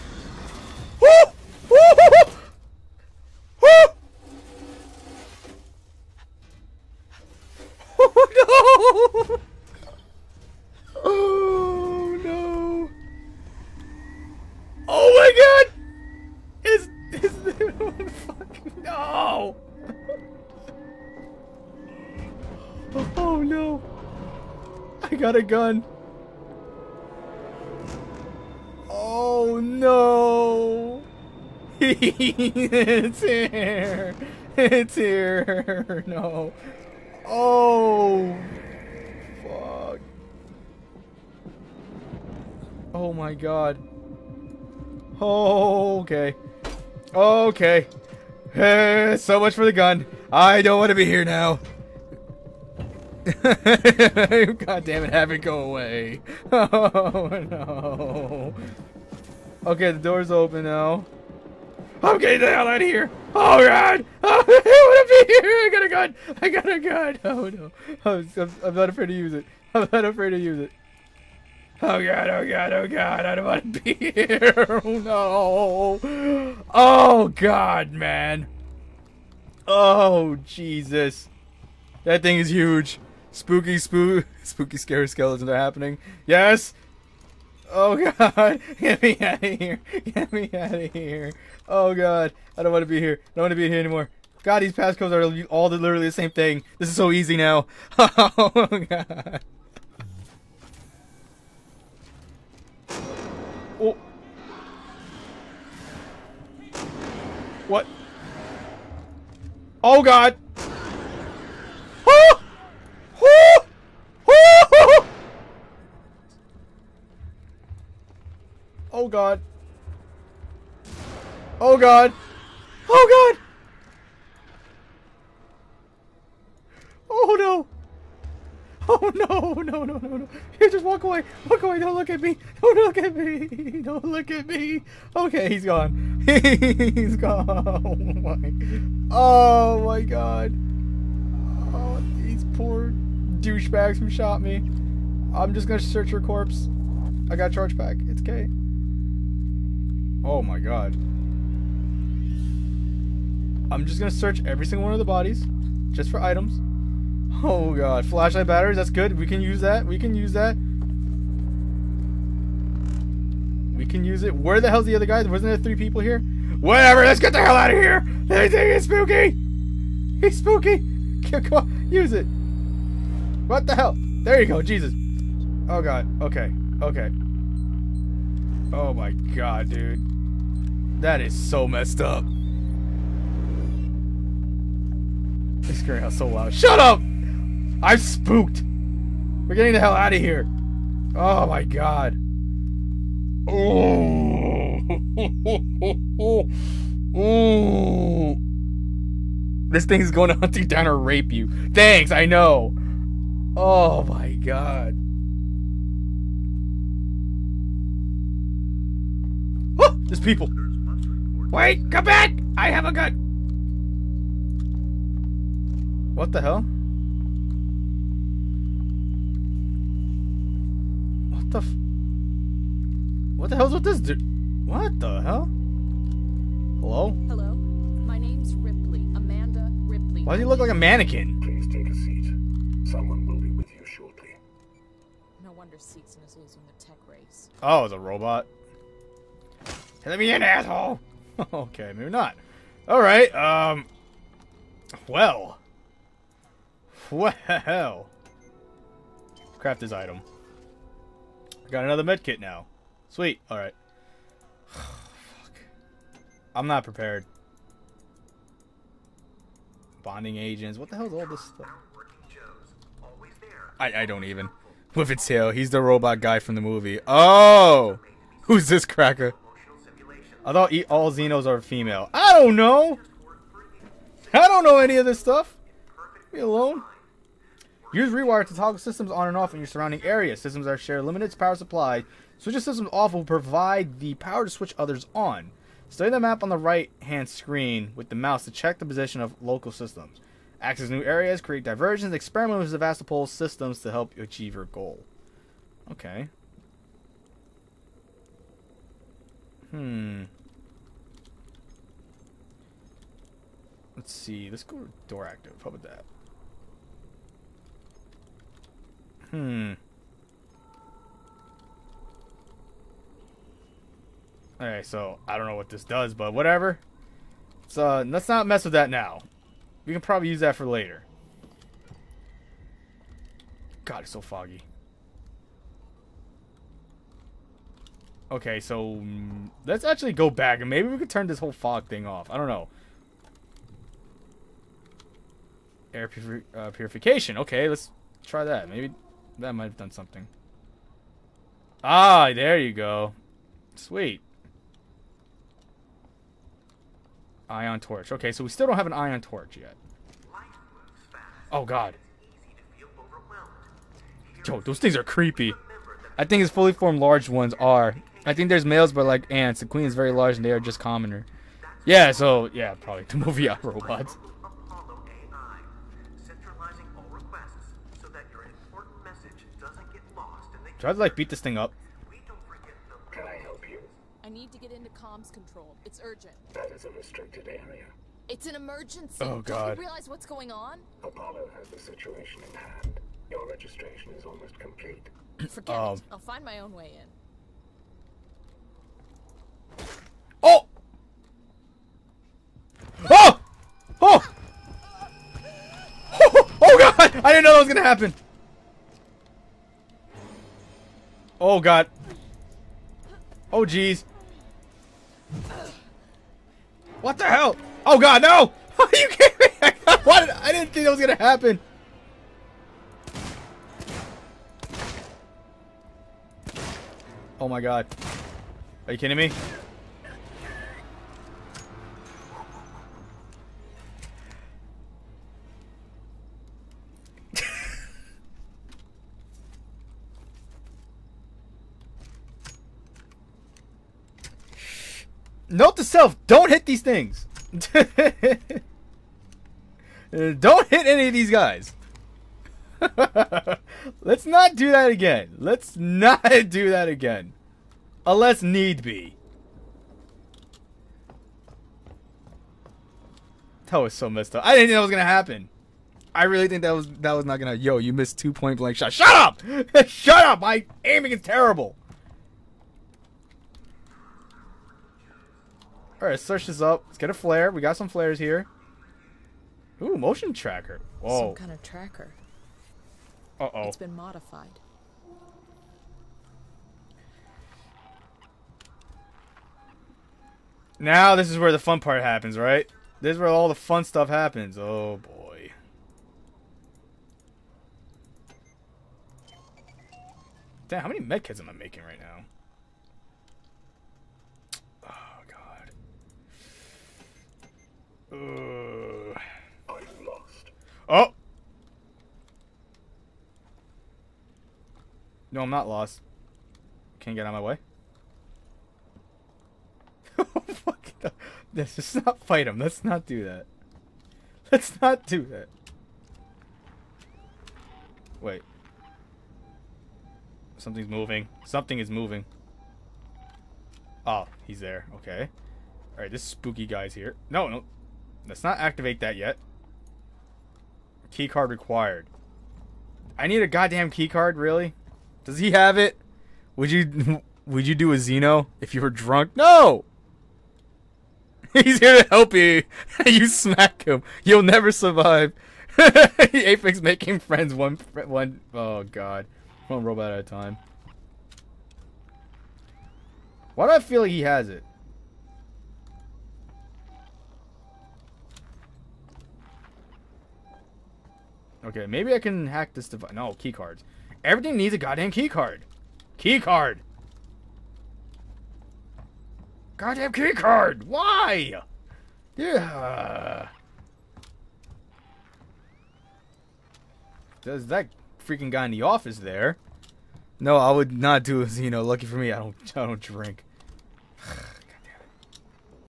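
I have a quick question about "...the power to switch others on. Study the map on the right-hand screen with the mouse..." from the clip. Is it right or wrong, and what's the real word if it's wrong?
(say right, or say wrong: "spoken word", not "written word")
right.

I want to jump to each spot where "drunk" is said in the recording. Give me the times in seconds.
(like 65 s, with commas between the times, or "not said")
538 s.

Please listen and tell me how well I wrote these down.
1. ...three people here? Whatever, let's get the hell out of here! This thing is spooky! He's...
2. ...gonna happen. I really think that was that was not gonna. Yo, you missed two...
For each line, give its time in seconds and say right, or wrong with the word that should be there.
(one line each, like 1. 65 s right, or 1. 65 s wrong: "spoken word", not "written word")
1. 165 s right
2. 454 s right.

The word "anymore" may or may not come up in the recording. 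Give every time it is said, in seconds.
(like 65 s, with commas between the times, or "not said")
93 s.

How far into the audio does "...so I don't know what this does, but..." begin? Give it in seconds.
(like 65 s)
314 s.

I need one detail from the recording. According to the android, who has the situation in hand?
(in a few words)
Apollo.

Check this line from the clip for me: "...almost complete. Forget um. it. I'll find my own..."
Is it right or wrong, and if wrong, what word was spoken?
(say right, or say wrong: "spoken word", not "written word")
right.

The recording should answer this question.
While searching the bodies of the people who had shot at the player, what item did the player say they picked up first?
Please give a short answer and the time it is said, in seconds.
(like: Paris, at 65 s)
Charge pack, at 147 s.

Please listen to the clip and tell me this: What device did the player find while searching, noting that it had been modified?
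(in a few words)
Motion tracker.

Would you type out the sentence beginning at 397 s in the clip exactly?
I didn't know that was gonna happen.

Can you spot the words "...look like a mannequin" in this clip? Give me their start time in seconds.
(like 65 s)
230 s.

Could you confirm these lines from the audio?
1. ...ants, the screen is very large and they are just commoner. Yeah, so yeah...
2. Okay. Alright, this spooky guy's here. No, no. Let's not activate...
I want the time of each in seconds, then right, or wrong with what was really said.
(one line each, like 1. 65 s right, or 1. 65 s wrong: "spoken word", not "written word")
1. 359 s wrong: "queen", not "screen"
2. 524 s right.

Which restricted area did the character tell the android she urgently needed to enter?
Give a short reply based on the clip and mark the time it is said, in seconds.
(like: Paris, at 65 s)
Comms control, at 374 s.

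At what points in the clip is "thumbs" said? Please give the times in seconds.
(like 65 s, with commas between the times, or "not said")
not said.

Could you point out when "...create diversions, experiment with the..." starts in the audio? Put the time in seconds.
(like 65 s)
291 s.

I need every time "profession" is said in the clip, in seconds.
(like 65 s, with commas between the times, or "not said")
not said.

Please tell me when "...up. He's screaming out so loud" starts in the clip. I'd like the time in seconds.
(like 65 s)
182 s.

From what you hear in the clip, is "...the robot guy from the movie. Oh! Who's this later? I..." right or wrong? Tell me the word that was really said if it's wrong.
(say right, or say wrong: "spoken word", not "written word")
wrong: "cracker", not "later".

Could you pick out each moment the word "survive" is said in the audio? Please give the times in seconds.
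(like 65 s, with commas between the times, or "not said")
544 s.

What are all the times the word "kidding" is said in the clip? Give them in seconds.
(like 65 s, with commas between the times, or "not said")
409 s, 418 s.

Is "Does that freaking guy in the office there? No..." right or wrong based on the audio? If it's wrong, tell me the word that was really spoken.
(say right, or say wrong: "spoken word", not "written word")
right.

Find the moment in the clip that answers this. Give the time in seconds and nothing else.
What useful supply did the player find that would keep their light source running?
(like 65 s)
158 s.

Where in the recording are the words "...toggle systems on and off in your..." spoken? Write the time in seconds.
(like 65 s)
278 s.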